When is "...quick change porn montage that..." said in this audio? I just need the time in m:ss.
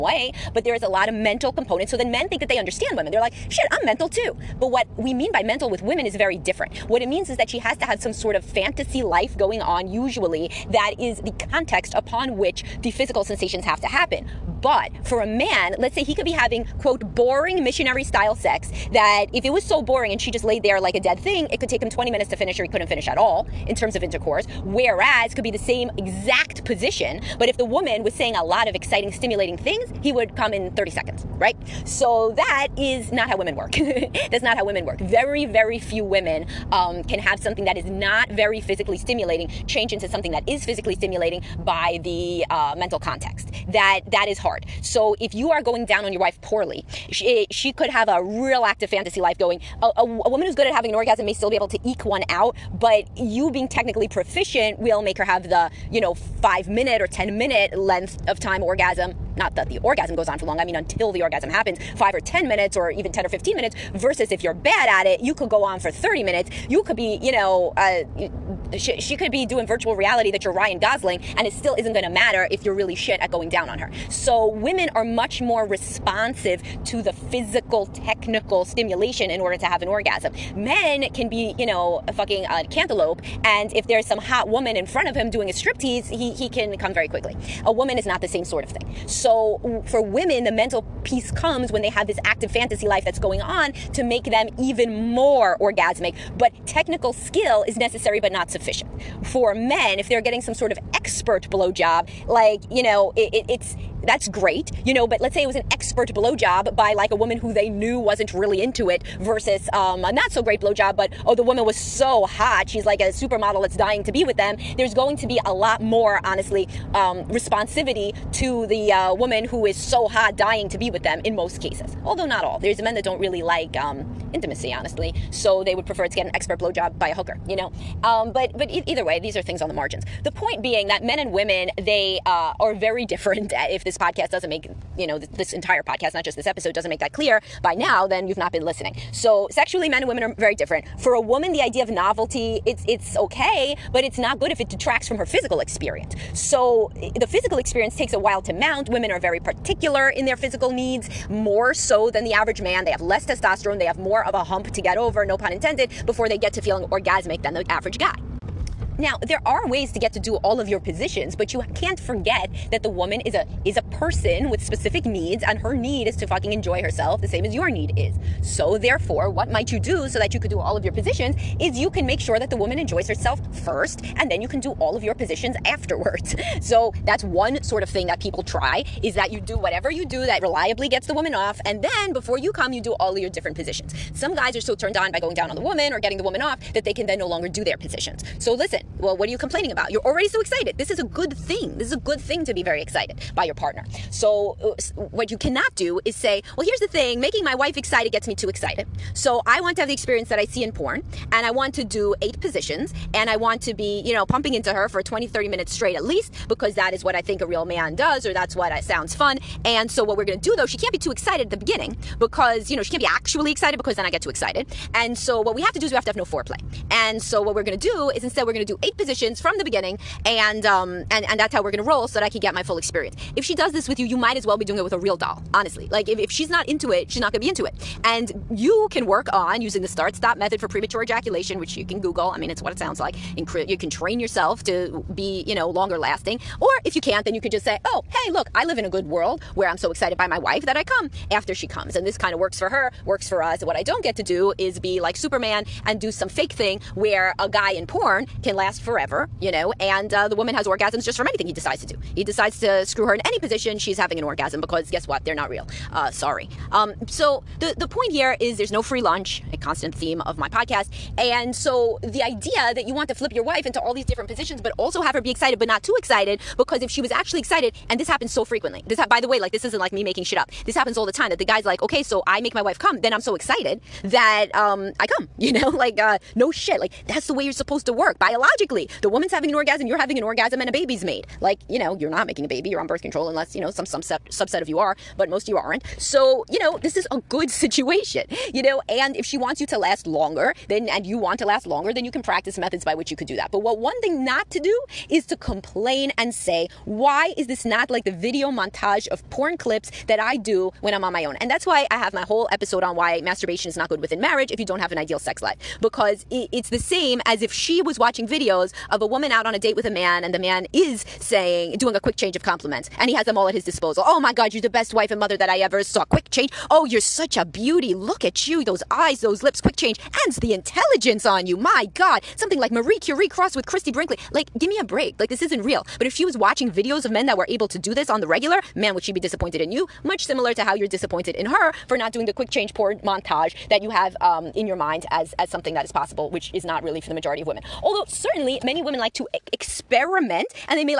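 5:32.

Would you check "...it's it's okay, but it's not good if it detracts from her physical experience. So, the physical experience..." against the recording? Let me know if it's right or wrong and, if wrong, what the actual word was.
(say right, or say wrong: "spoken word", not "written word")
right.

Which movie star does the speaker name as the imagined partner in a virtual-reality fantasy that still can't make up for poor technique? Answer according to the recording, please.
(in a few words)
Ryan Gosling.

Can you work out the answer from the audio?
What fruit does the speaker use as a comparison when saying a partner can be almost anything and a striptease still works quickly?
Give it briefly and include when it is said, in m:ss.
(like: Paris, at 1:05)
Cantaloupe, at 1:22.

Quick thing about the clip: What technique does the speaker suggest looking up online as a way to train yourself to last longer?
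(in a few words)
Start stop method.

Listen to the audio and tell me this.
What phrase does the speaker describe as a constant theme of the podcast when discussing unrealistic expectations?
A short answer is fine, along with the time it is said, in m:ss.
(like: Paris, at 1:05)
No free lunch, at 4:18.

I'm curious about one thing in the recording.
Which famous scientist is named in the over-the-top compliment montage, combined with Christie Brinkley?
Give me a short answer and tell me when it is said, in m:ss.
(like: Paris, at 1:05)
Marie Curie, at 5:22.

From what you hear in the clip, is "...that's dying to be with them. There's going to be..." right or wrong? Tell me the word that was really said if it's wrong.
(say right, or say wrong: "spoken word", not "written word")
right.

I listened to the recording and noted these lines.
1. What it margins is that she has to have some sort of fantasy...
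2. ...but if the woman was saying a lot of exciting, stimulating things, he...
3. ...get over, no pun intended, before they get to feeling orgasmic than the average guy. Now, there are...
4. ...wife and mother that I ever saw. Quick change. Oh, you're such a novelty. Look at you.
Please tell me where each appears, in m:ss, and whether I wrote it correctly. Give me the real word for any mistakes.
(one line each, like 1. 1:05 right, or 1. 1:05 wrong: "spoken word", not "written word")
1. 0:06 wrong: "means", not "margins"
2. 0:27 right
3. 2:34 right
4. 5:14 wrong: "beauty", not "novelty".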